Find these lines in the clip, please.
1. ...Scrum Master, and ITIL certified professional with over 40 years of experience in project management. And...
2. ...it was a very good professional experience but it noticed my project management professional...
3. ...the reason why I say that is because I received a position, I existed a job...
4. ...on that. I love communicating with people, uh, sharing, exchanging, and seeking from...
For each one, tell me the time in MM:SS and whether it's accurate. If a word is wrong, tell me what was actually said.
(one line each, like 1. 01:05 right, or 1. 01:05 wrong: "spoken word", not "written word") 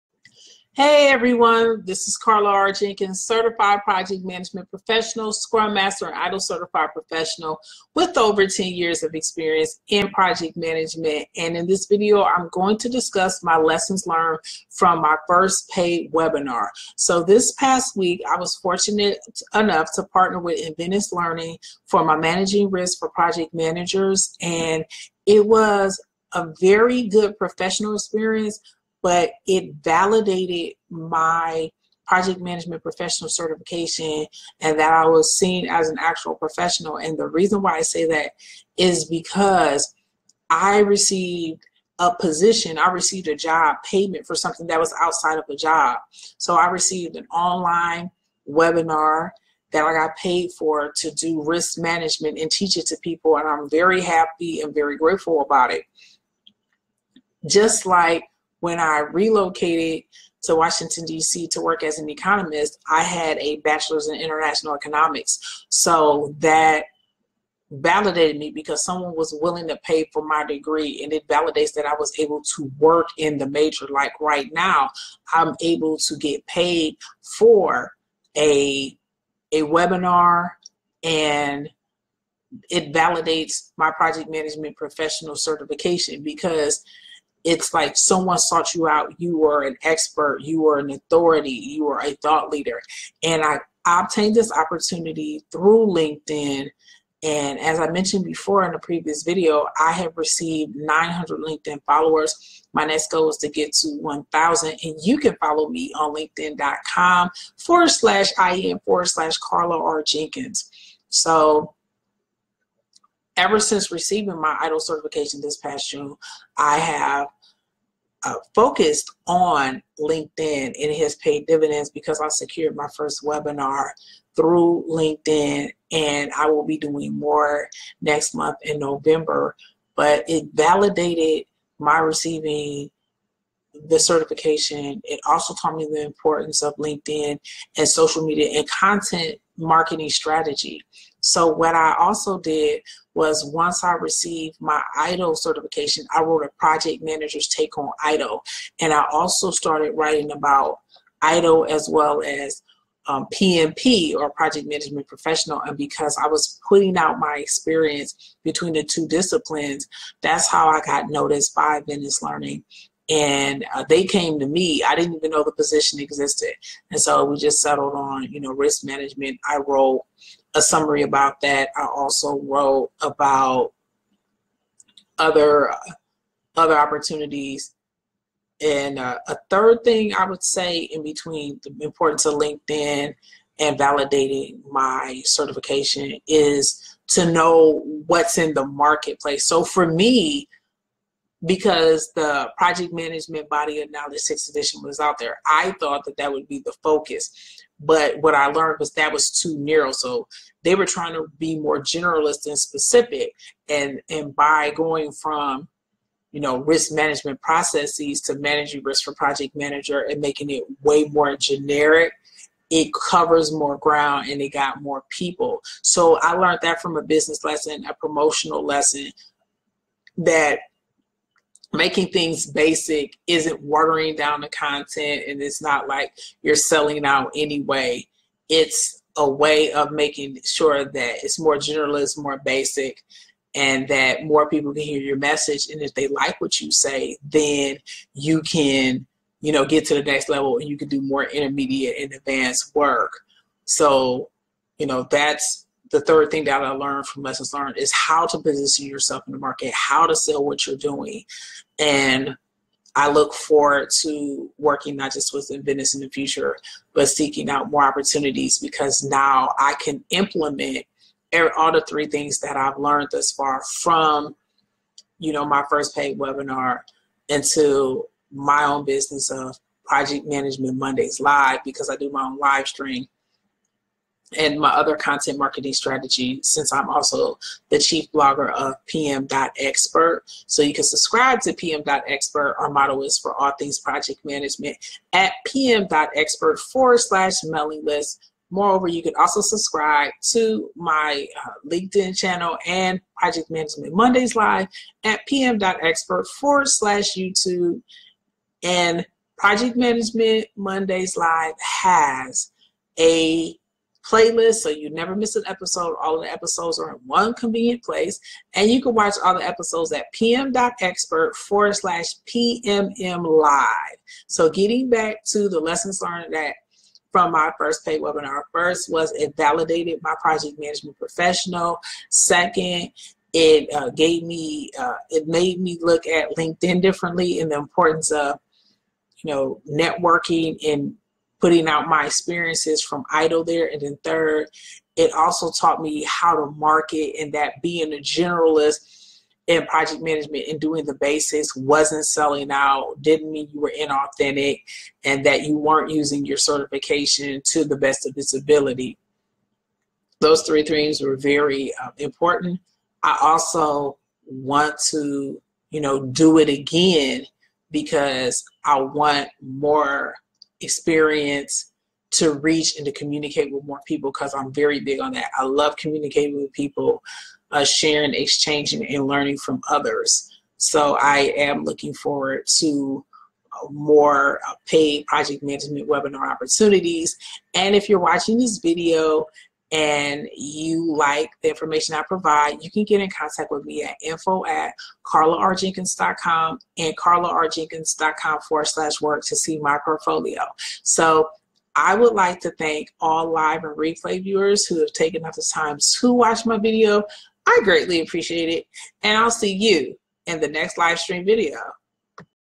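1. 00:05 wrong: "10", not "40"
2. 00:25 wrong: "validated", not "noticed"
3. 00:37 wrong: "received", not "existed"
4. 06:05 wrong: "learning", not "seeking".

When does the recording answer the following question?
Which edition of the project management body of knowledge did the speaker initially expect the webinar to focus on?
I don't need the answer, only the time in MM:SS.
03:14.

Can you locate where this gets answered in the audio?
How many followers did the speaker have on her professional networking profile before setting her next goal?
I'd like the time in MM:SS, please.
01:40.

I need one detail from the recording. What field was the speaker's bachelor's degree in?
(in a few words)
international economics.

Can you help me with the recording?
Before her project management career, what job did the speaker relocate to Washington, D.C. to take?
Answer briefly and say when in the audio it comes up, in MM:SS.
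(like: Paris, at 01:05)
economist, at 01:02.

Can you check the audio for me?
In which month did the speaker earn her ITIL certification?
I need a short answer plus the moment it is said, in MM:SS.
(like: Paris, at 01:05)
June, at 01:55.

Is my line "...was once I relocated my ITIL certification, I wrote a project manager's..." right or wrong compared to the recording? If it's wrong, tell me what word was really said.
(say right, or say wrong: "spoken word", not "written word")
wrong: "received", not "relocated".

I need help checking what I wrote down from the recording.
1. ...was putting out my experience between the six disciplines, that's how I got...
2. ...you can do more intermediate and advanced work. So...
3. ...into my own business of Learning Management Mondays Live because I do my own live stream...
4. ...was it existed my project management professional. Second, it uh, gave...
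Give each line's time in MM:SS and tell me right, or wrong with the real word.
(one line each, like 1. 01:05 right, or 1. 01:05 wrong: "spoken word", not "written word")
1. 02:36 wrong: "two", not "six"
2. 04:00 right
3. 04:27 wrong: "Project", not "Learning"
4. 05:18 wrong: "validated", not "existed".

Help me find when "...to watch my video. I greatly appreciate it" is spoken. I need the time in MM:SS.
06:36.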